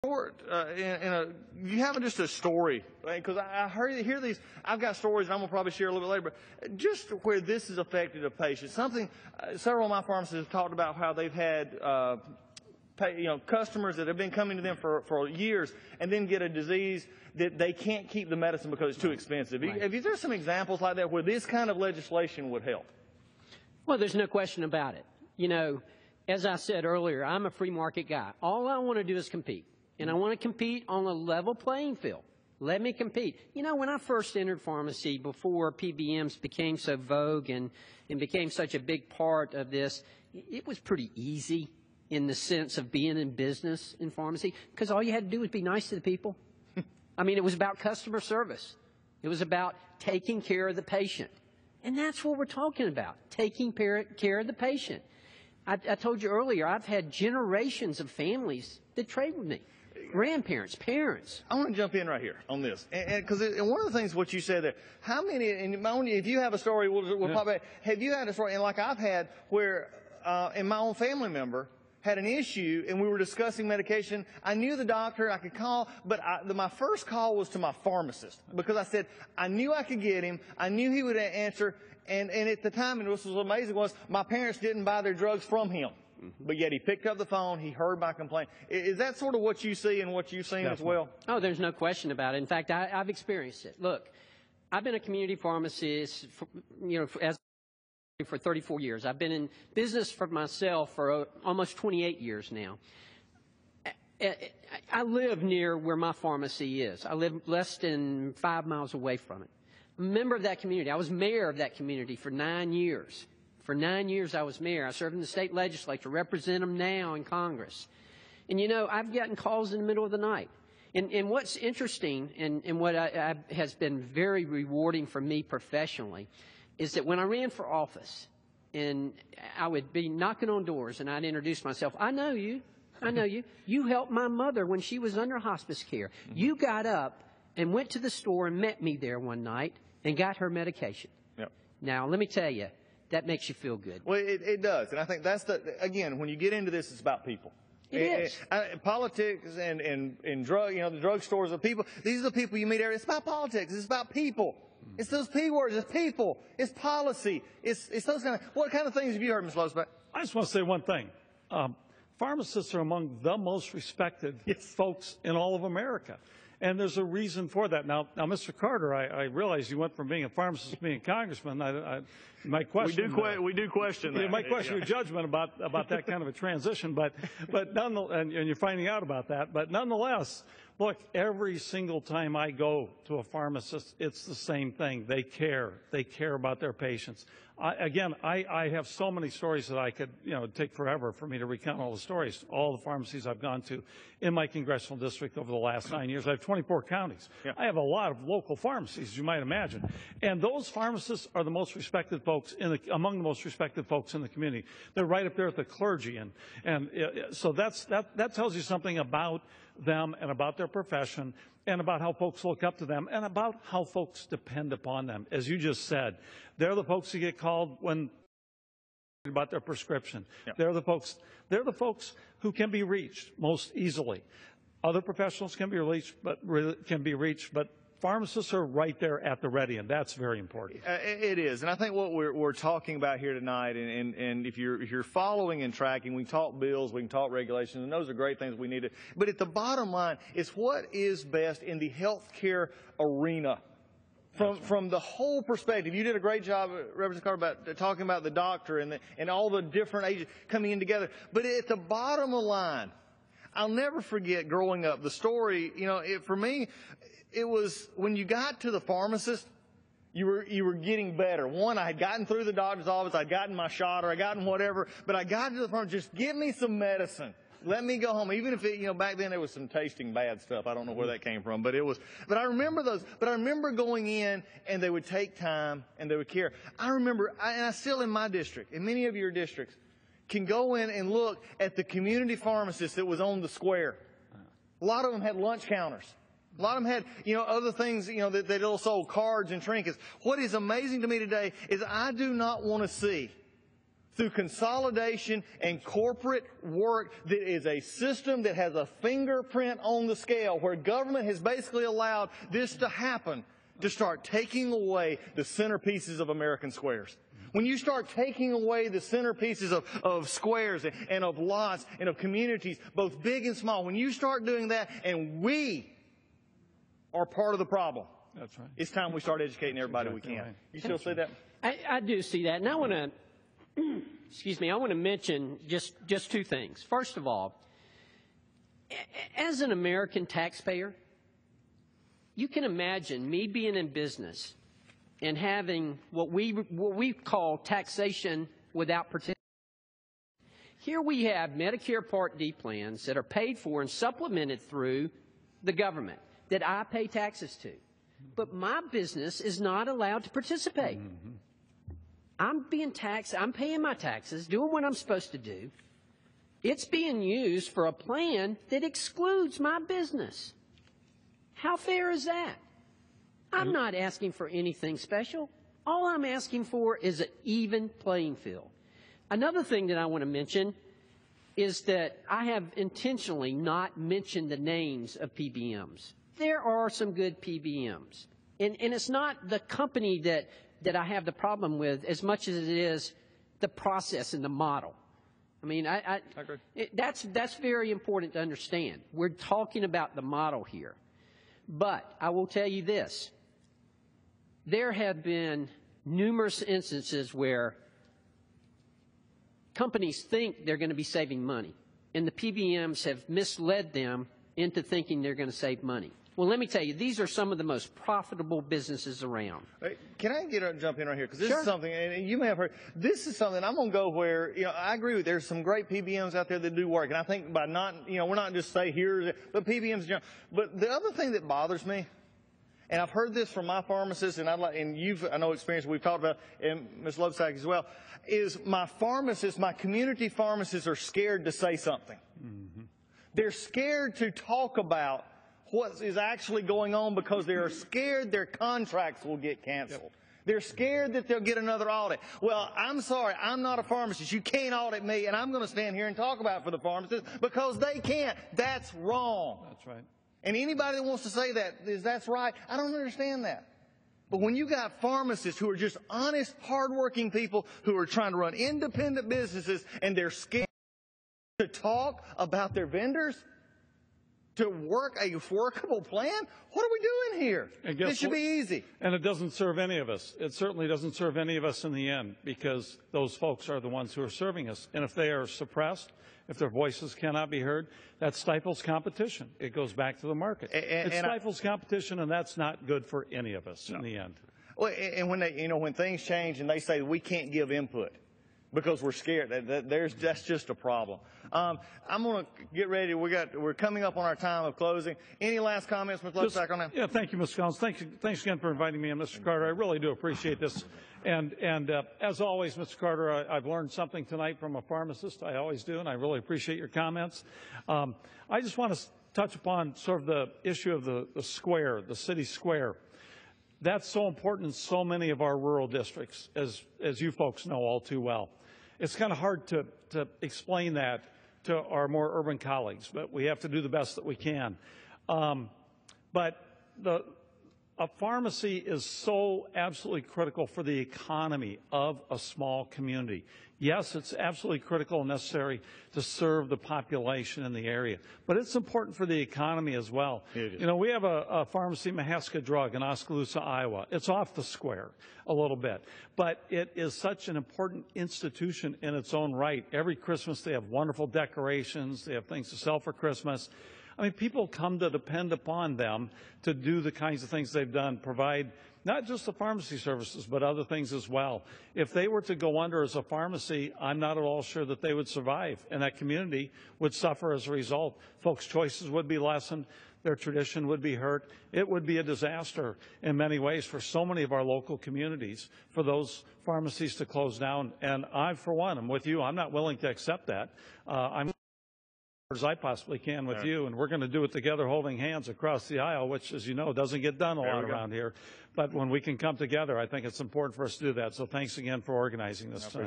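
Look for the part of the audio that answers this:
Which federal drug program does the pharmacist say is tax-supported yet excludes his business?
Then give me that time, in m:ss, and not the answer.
5:41.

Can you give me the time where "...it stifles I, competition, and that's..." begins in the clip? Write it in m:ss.
8:01.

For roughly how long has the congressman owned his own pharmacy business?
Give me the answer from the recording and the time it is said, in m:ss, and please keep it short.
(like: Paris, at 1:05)
almost 28 years, at 1:41.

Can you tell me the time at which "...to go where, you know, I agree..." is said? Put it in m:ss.
6:53.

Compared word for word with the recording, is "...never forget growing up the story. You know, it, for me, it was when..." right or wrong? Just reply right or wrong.
right.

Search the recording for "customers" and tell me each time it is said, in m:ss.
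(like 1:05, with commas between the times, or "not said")
0:13, 0:47.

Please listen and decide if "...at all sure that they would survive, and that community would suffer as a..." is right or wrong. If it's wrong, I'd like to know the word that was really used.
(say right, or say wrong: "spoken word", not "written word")
right.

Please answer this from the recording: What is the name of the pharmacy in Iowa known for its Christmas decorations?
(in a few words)
Mahaska Drug.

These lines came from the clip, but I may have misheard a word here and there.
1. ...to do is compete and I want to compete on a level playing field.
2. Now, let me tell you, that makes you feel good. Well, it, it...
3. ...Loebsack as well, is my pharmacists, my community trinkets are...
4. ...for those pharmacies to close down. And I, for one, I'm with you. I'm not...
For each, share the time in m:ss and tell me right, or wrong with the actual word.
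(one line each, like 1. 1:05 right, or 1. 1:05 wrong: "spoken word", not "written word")
1. 0:28 right
2. 2:21 right
3. 7:07 wrong: "pharmacists", not "trinkets"
4. 9:35 right.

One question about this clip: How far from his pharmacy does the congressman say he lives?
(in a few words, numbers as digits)
less than 5 miles.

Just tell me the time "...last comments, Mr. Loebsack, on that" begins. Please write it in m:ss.
8:15.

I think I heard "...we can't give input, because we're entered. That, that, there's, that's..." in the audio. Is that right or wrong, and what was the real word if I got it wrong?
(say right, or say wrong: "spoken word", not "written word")
wrong: "scared", not "entered".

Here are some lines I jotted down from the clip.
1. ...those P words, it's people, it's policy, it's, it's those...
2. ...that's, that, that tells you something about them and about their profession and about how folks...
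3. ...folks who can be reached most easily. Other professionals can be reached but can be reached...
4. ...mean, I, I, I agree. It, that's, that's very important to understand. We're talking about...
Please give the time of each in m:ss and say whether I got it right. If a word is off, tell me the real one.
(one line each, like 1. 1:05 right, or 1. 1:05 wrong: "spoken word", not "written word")
1. 2:35 right
2. 3:27 right
3. 3:41 right
4. 6:25 right.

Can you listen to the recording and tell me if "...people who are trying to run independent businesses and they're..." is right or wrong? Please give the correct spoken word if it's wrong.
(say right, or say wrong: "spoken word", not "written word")
right.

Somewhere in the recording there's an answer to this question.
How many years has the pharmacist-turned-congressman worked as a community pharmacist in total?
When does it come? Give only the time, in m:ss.
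1:38.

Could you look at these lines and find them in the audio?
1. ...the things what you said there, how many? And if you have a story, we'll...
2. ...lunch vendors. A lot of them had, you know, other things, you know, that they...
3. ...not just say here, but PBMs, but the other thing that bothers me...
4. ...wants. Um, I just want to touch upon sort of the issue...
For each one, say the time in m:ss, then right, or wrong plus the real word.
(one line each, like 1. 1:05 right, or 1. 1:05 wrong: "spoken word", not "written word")
1. 1:03 right
2. 4:45 wrong: "counters", not "vendors"
3. 6:58 right
4. 8:26 wrong: "comments", not "wants".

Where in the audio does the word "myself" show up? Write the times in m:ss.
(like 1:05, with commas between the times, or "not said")
1:40, 2:11.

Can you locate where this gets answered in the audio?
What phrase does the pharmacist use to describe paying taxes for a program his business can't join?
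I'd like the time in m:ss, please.
5:37.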